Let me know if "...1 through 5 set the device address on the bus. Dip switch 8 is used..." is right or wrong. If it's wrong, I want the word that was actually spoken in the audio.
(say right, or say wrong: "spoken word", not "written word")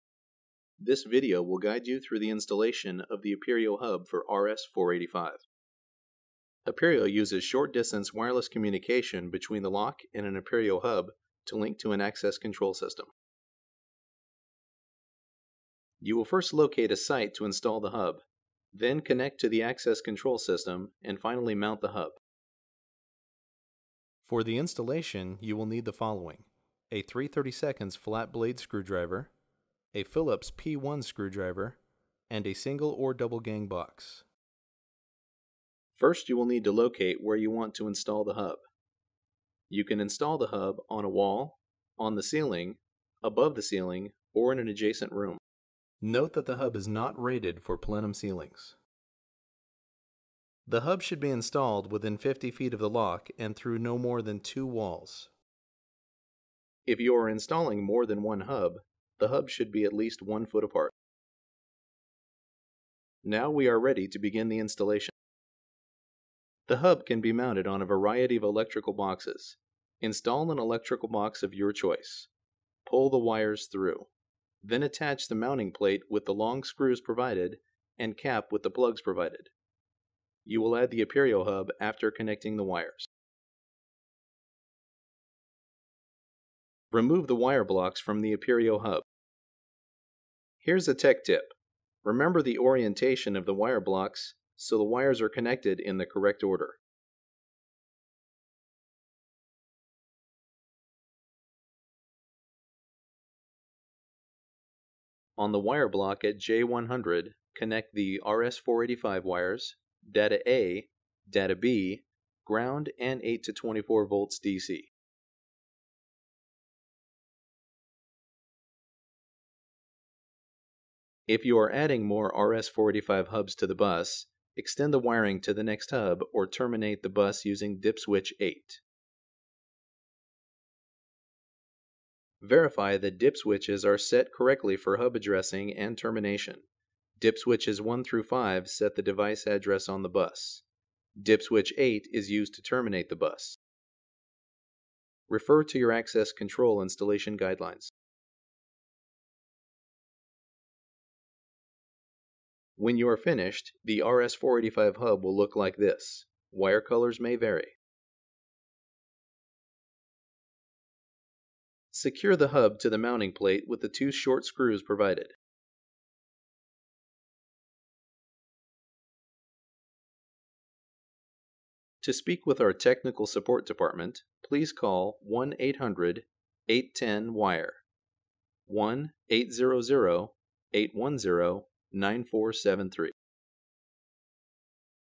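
right.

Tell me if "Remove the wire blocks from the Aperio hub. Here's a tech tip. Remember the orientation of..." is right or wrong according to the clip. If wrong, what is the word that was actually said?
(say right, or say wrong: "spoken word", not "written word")
right.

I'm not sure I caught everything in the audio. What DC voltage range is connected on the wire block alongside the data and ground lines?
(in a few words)
8 to 24 volts.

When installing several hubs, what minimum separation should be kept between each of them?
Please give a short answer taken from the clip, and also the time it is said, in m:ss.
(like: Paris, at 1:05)
one foot, at 1:00.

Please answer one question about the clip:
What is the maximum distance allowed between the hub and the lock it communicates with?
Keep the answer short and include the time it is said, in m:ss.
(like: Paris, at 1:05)
50 feet, at 0:52.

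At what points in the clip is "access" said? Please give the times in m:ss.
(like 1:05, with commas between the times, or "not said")
0:12, 0:19, 2:25.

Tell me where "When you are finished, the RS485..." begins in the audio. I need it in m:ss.
2:32.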